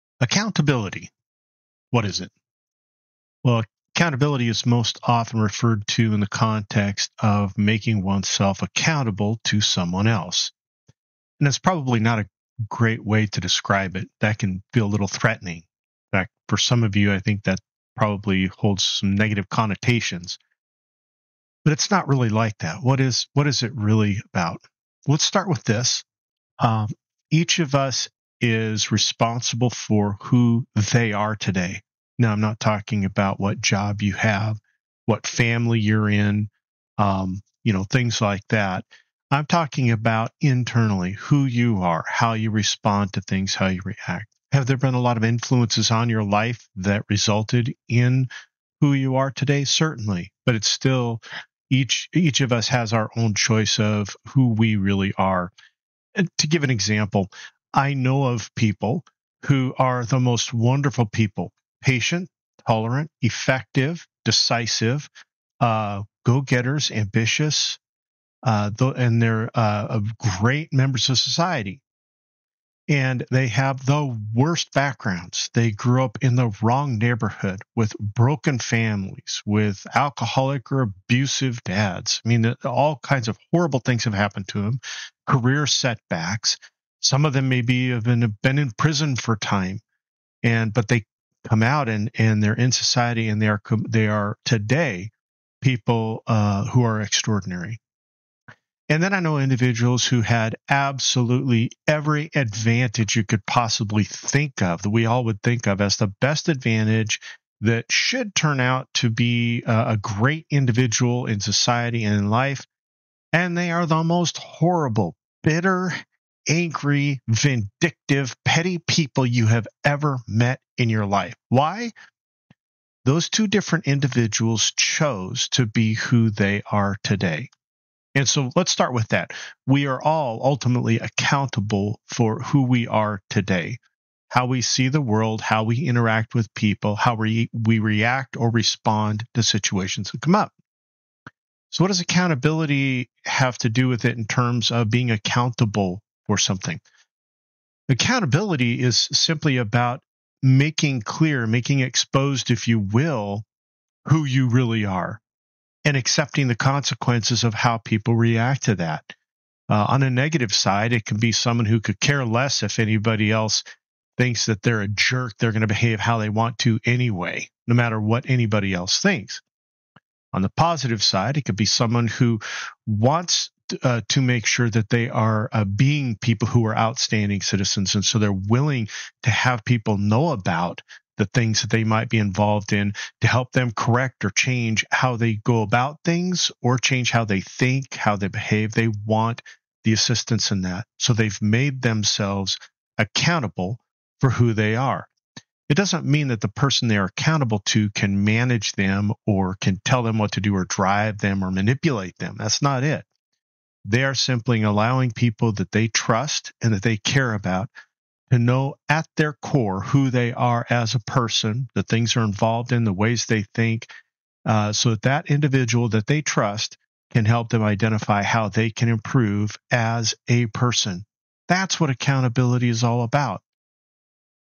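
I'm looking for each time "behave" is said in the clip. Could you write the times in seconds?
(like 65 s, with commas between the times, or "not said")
165 s, 188 s.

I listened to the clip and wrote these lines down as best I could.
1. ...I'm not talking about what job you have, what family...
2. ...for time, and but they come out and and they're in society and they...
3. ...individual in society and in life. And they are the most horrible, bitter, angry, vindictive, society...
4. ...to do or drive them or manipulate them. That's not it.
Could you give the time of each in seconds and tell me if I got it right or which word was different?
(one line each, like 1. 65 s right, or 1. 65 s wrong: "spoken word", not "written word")
1. 32 s right
2. 89 s right
3. 110 s wrong: "petty", not "society"
4. 200 s right.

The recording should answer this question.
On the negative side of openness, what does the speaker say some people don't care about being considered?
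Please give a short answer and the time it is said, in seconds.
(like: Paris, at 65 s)
a jerk, at 164 s.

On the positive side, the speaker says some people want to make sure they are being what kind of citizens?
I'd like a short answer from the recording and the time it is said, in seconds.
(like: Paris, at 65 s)
outstanding citizens, at 176 s.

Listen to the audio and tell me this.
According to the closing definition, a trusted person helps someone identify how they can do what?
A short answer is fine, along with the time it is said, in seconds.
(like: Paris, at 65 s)
improve, at 218 s.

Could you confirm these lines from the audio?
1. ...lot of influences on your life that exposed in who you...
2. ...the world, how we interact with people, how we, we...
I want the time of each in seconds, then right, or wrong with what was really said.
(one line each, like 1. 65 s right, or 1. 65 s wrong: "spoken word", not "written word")
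1. 44 s wrong: "resulted", not "exposed"
2. 134 s right.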